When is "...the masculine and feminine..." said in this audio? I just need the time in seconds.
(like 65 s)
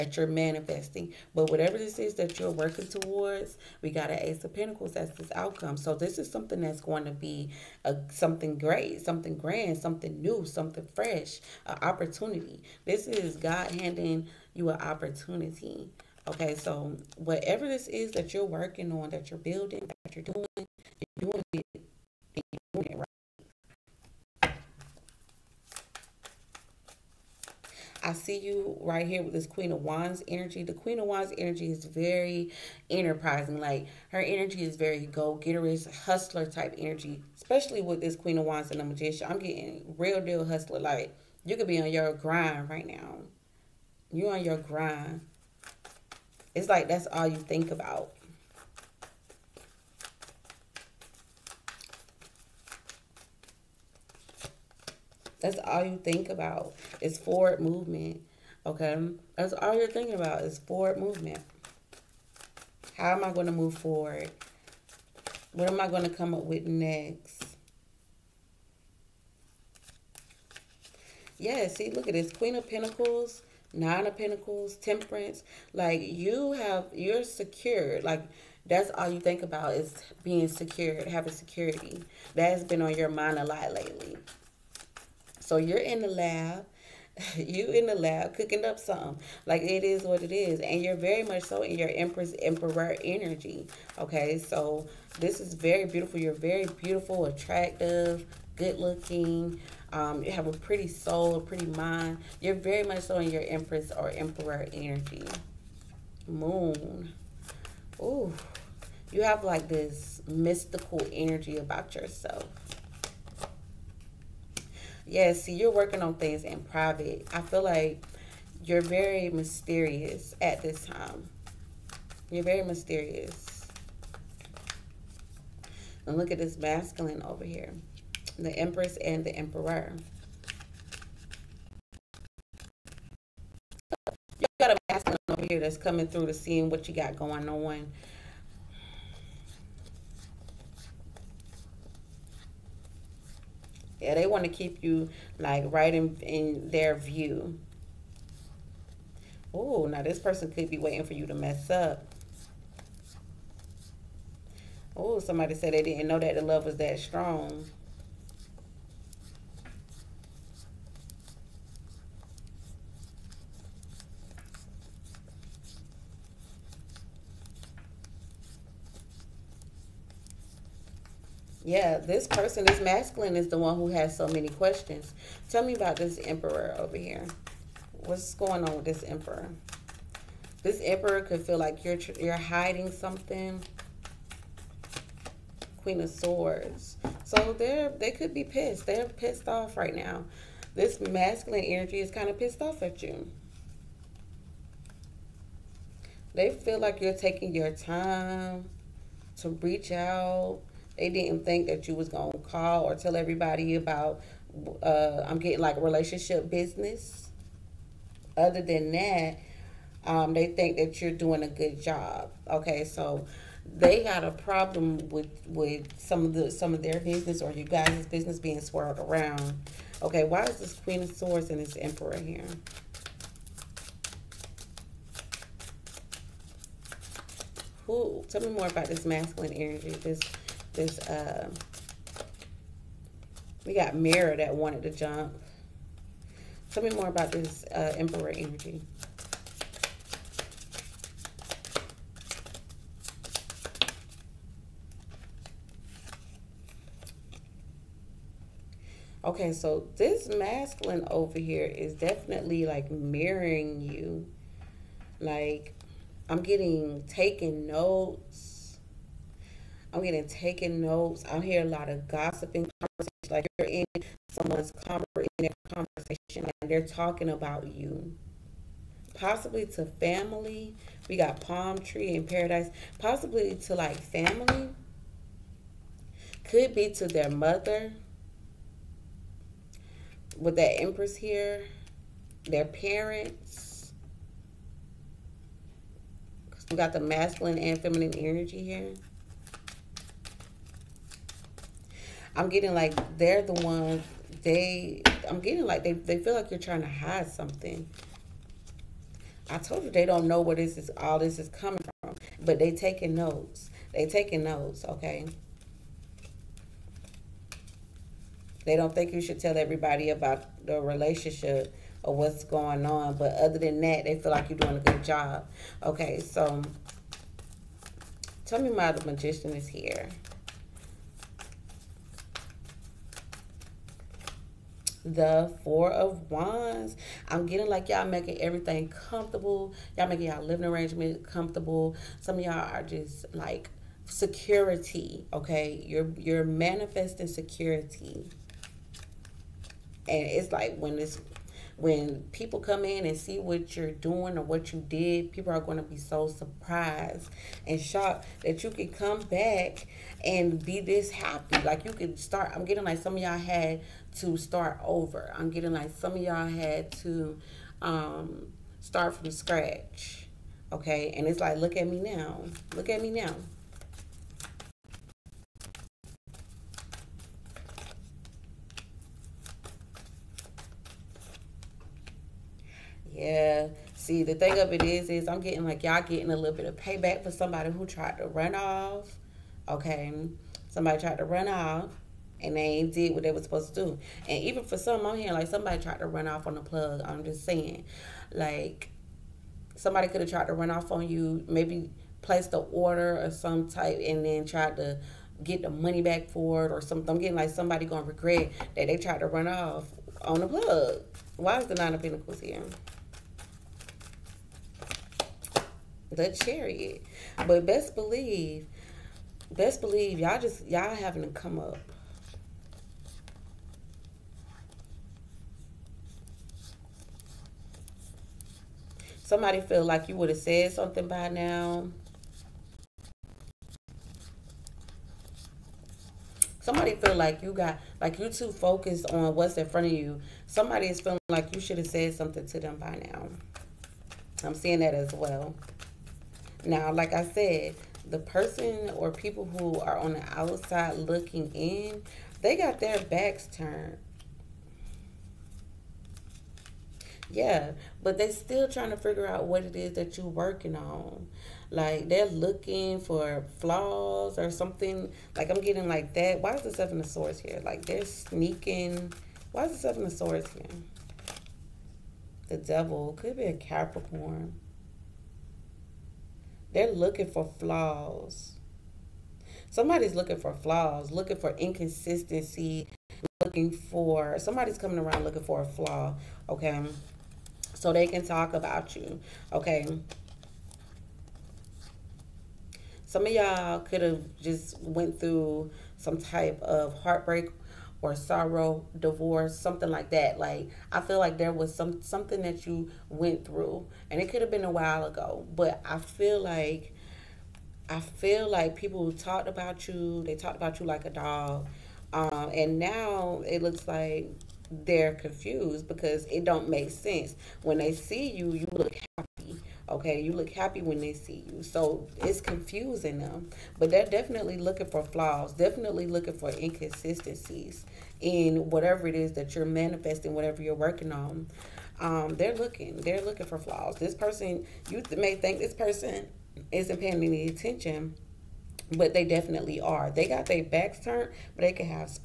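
286 s.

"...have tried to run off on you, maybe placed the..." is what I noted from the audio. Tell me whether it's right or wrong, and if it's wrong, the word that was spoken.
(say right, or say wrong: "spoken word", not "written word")
right.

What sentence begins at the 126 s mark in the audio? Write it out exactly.
And look at this masculine over here.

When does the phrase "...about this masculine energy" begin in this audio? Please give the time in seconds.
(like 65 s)
228 s.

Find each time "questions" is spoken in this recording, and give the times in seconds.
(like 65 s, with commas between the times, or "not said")
174 s.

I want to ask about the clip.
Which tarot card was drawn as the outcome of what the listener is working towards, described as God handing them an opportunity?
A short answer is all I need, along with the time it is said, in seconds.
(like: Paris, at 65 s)
Ace of Pentacles, at 4 s.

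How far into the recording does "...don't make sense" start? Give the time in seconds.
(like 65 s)
506 s.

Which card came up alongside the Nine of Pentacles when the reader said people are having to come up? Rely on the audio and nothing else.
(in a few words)
The Chariot.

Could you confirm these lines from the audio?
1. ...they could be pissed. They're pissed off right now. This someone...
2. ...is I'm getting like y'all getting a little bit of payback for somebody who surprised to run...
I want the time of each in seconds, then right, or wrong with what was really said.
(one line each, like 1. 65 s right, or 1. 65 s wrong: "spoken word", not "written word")
1. 187 s wrong: "masculine", not "someone"
2. 375 s wrong: "tried", not "surprised".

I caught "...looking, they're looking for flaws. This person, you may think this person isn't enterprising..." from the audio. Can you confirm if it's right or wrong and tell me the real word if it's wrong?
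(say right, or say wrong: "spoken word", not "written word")
wrong: "paying", not "enterprising".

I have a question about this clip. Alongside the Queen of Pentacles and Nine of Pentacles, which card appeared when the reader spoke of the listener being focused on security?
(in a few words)
Temperance.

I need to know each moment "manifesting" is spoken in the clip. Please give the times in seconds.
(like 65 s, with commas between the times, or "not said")
0 s, 336 s, 519 s.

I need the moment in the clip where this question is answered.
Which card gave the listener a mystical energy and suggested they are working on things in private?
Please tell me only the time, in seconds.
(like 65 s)
106 s.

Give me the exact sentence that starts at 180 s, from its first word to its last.
This emperor could feel like you're you're hiding something.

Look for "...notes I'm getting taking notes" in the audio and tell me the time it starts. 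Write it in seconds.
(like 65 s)
257 s.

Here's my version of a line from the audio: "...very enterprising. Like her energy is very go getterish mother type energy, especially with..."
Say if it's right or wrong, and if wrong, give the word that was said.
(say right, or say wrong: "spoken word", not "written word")
wrong: "hustler", not "mother".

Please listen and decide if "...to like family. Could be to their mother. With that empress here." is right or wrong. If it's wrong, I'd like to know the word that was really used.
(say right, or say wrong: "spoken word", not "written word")
right.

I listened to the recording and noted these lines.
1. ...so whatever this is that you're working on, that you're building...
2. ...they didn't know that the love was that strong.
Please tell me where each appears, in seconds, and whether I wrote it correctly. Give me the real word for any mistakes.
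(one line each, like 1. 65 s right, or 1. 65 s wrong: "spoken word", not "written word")
1. 16 s right
2. 155 s right.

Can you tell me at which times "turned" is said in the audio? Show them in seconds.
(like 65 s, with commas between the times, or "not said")
443 s, 531 s.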